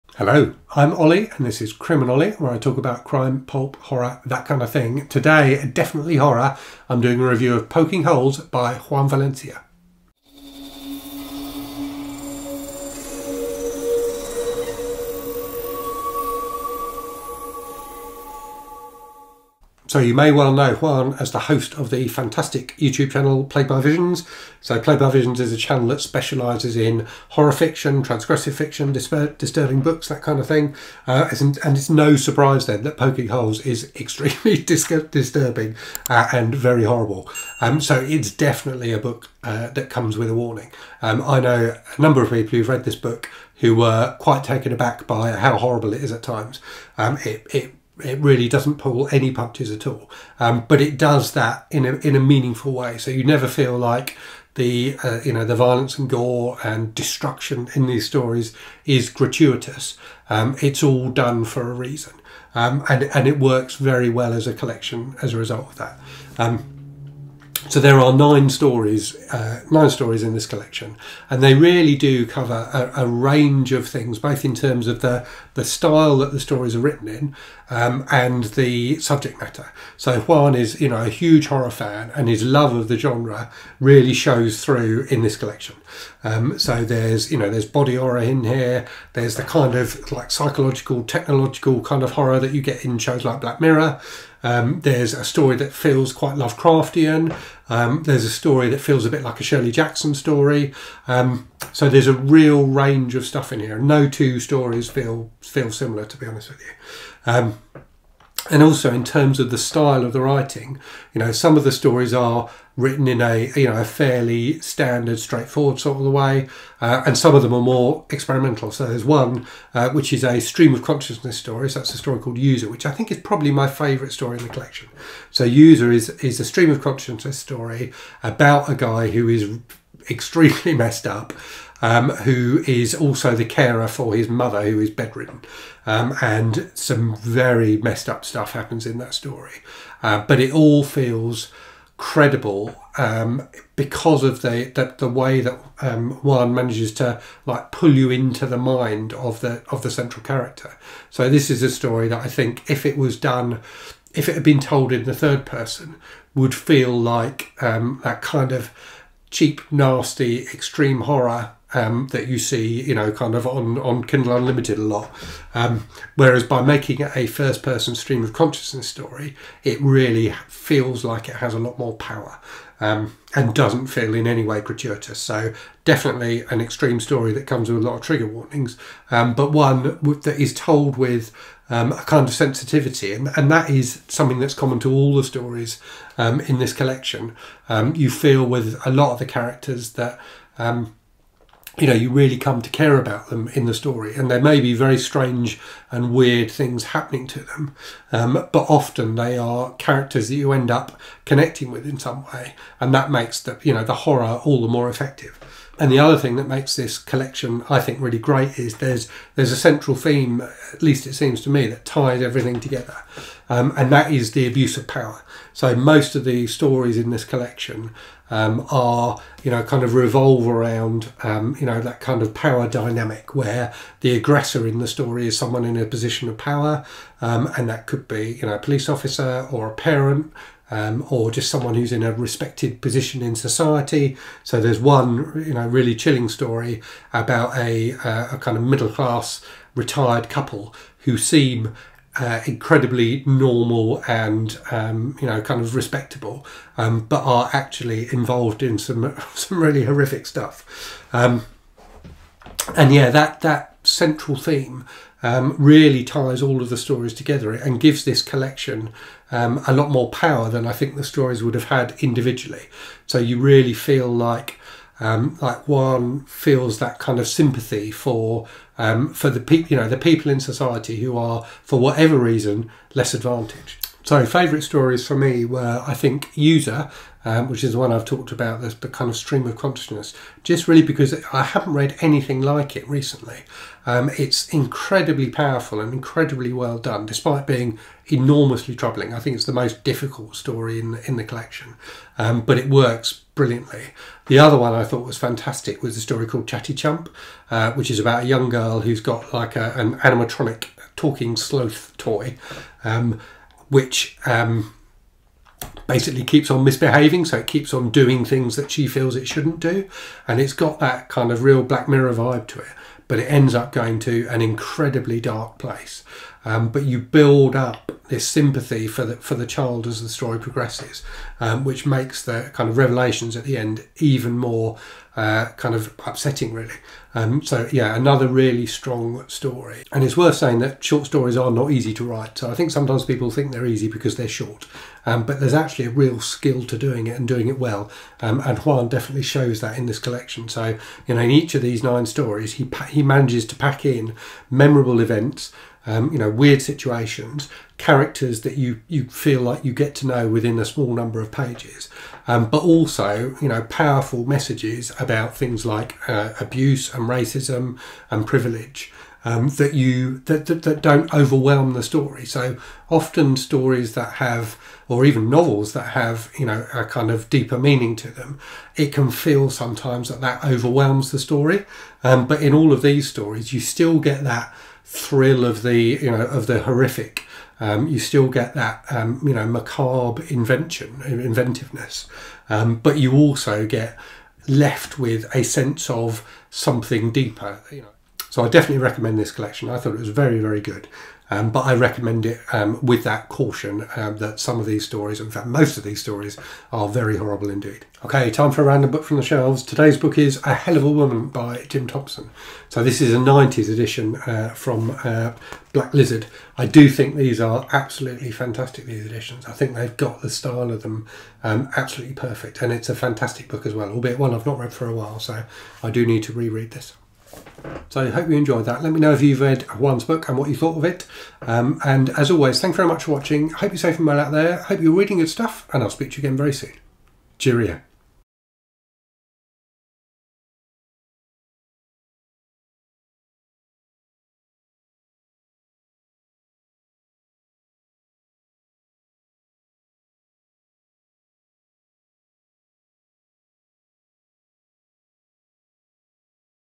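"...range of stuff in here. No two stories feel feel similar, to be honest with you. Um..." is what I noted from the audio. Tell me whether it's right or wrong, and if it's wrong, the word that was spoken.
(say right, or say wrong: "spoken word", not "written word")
right.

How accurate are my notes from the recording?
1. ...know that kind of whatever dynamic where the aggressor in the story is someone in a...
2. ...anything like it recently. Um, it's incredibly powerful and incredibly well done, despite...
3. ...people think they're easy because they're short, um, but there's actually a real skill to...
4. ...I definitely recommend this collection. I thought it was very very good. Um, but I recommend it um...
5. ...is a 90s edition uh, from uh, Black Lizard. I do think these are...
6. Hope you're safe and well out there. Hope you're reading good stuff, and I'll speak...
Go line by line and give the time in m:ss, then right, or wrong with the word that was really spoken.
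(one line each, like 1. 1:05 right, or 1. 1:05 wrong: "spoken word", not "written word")
1. 3:41 wrong: "power", not "whatever"
2. 4:42 right
3. 5:33 right
4. 6:28 right
5. 6:42 right
6. 7:03 right.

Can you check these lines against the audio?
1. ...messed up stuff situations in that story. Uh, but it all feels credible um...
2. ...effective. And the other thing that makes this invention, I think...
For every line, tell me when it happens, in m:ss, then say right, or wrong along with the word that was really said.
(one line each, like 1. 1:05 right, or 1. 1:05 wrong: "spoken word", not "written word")
1. 2:17 wrong: "happens", not "situations"
2. 3:24 wrong: "collection", not "invention".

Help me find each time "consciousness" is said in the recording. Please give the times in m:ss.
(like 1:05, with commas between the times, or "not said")
2:00, 2:06, 2:48, 4:39.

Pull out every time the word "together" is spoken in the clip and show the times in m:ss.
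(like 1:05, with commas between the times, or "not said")
3:32, 4:17.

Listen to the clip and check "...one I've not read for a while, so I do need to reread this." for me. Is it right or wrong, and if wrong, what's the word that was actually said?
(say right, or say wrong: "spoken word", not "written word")
right.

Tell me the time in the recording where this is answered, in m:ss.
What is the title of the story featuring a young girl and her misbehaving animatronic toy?
4:56.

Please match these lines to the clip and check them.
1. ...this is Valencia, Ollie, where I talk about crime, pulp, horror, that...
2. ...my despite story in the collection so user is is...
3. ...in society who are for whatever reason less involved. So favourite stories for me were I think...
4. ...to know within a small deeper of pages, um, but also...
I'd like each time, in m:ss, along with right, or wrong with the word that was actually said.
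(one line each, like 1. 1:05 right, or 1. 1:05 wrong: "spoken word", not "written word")
1. 0:01 wrong: "Criminally", not "Valencia"
2. 2:03 wrong: "favorite", not "despite"
3. 4:30 wrong: "advantaged", not "involved"
4. 5:49 wrong: "number", not "deeper".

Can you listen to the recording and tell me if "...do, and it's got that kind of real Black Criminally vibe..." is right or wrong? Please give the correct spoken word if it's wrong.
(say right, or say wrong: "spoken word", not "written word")
wrong: "Mirror", not "Criminally".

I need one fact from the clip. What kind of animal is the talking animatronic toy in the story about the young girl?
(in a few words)
Sloth.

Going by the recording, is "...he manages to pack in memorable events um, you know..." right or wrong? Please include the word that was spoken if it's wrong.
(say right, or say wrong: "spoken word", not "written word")
right.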